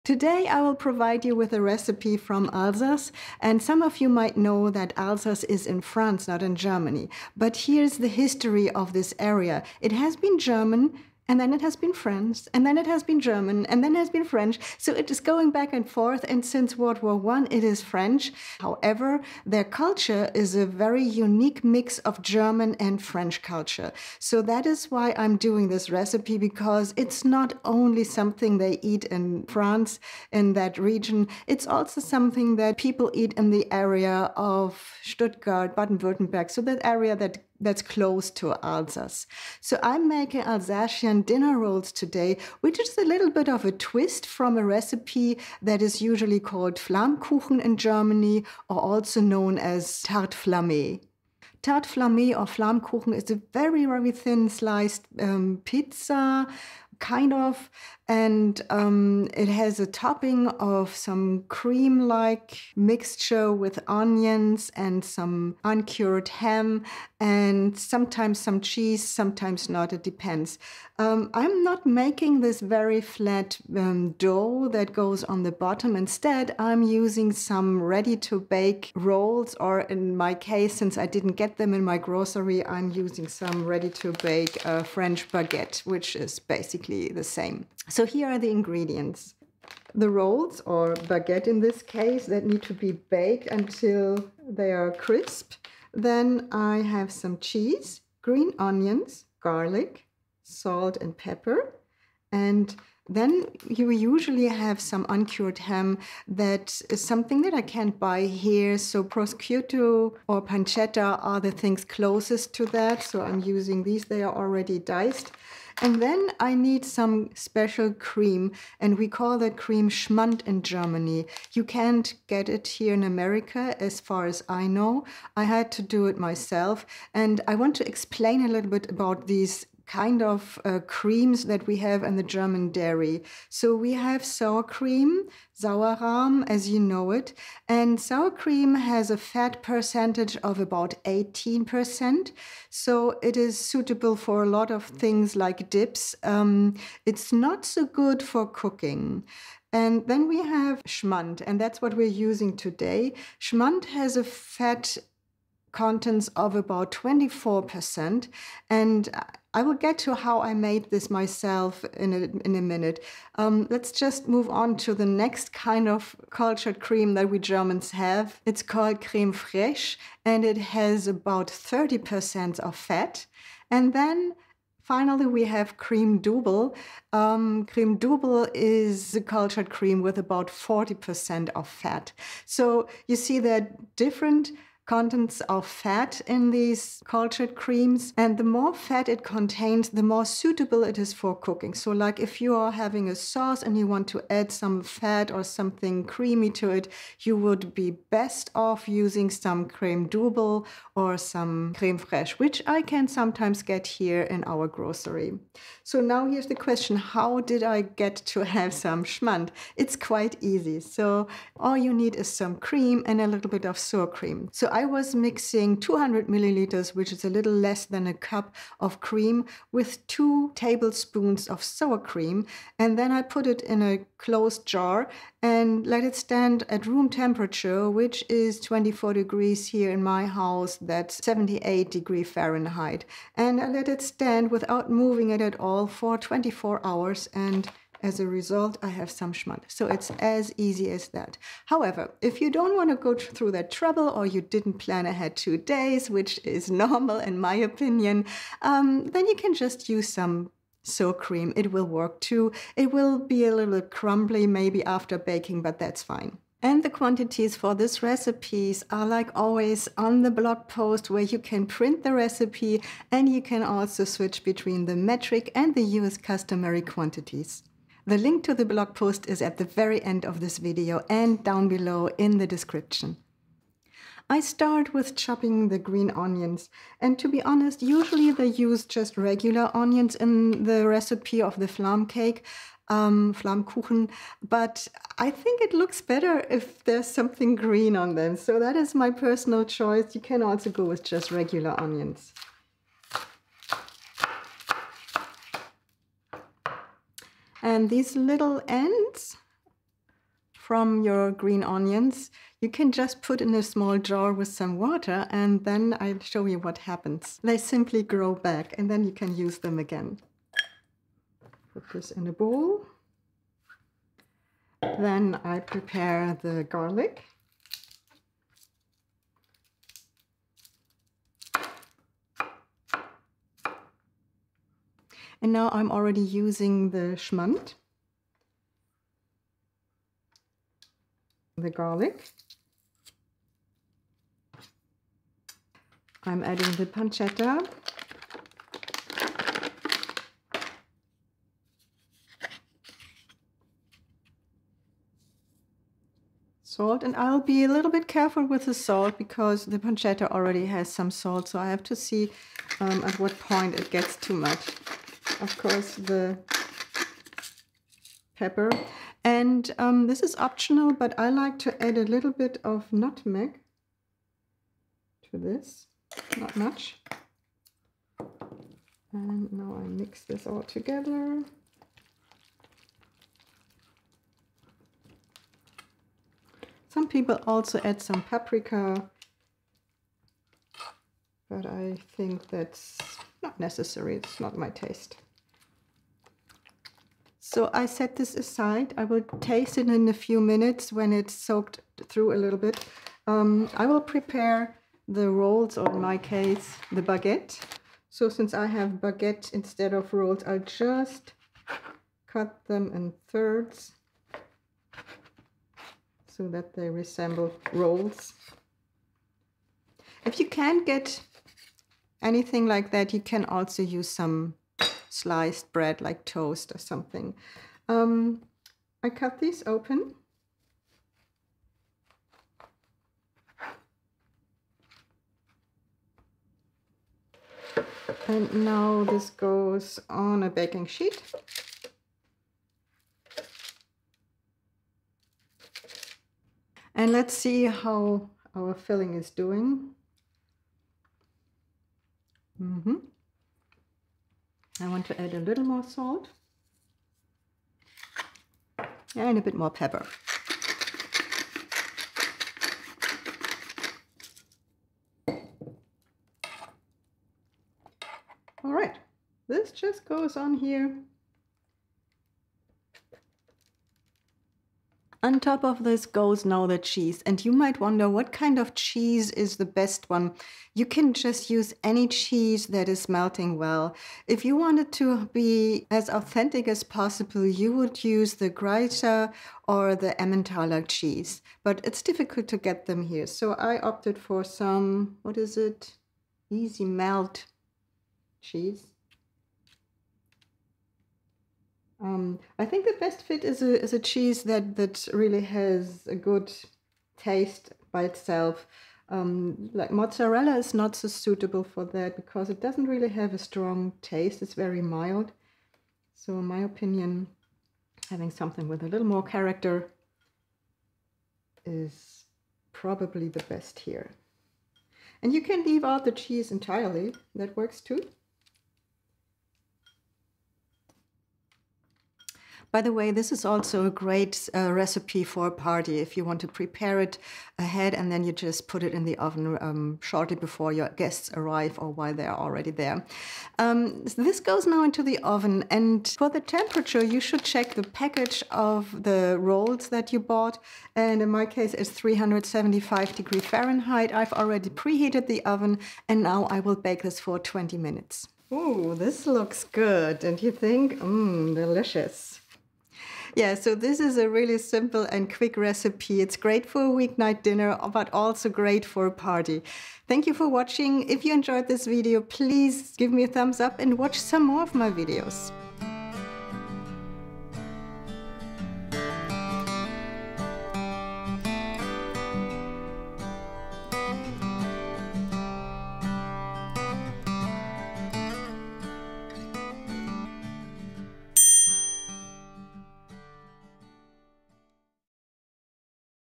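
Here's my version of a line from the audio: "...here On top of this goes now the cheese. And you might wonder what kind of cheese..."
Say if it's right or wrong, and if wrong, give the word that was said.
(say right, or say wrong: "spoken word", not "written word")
right.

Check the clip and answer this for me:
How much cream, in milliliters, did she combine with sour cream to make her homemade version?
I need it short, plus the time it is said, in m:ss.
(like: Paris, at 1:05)
200 milliliters, at 3:35.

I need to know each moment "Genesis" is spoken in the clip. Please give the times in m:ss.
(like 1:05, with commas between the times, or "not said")
not said.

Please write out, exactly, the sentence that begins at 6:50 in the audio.
If you can't get anything like that, you can also use some sliced bread like toast or something.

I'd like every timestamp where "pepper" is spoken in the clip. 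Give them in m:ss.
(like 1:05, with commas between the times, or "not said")
1:41, 5:58, 7:29.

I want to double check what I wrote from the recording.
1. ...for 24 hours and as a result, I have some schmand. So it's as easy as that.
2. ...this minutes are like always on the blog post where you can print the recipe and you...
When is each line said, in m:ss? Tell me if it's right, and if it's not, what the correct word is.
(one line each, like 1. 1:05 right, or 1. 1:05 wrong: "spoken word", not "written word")
1. 3:55 right
2. 4:17 wrong: "recipes", not "minutes".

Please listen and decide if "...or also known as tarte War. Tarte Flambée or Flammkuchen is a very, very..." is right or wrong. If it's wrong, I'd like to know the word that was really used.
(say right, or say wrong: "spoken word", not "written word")
wrong: "Flambée", not "War".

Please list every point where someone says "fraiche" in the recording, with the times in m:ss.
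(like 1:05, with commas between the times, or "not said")
2:49, 3:21.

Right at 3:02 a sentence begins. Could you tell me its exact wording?
So you see they're different contents of fat in these cultured creams.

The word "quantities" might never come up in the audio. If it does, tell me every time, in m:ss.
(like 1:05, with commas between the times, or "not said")
4:16, 4:26.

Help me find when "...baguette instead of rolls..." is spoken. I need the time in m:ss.
6:39.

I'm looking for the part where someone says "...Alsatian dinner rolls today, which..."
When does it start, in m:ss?
0:40.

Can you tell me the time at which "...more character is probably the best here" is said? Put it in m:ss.
8:29.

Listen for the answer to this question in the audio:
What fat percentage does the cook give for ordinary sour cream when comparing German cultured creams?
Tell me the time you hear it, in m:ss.
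2:21.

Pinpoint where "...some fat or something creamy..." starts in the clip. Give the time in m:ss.
3:14.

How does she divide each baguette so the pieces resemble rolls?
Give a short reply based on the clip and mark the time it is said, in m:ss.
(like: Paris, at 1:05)
thirds, at 6:43.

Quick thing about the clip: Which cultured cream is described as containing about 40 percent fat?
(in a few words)
crème double.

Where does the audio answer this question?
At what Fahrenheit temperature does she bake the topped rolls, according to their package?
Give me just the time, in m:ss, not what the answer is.
9:01.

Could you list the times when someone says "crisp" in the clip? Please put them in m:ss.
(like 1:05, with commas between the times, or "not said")
1:34.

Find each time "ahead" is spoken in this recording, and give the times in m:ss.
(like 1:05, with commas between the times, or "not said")
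4:05, 8:47.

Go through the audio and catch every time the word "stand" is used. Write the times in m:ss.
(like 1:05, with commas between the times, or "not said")
3:46, 3:54.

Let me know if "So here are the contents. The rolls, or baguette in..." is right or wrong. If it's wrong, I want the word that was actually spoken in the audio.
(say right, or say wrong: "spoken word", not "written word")
wrong: "ingredients", not "contents".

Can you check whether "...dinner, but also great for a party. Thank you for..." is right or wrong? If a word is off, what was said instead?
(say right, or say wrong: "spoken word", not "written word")
right.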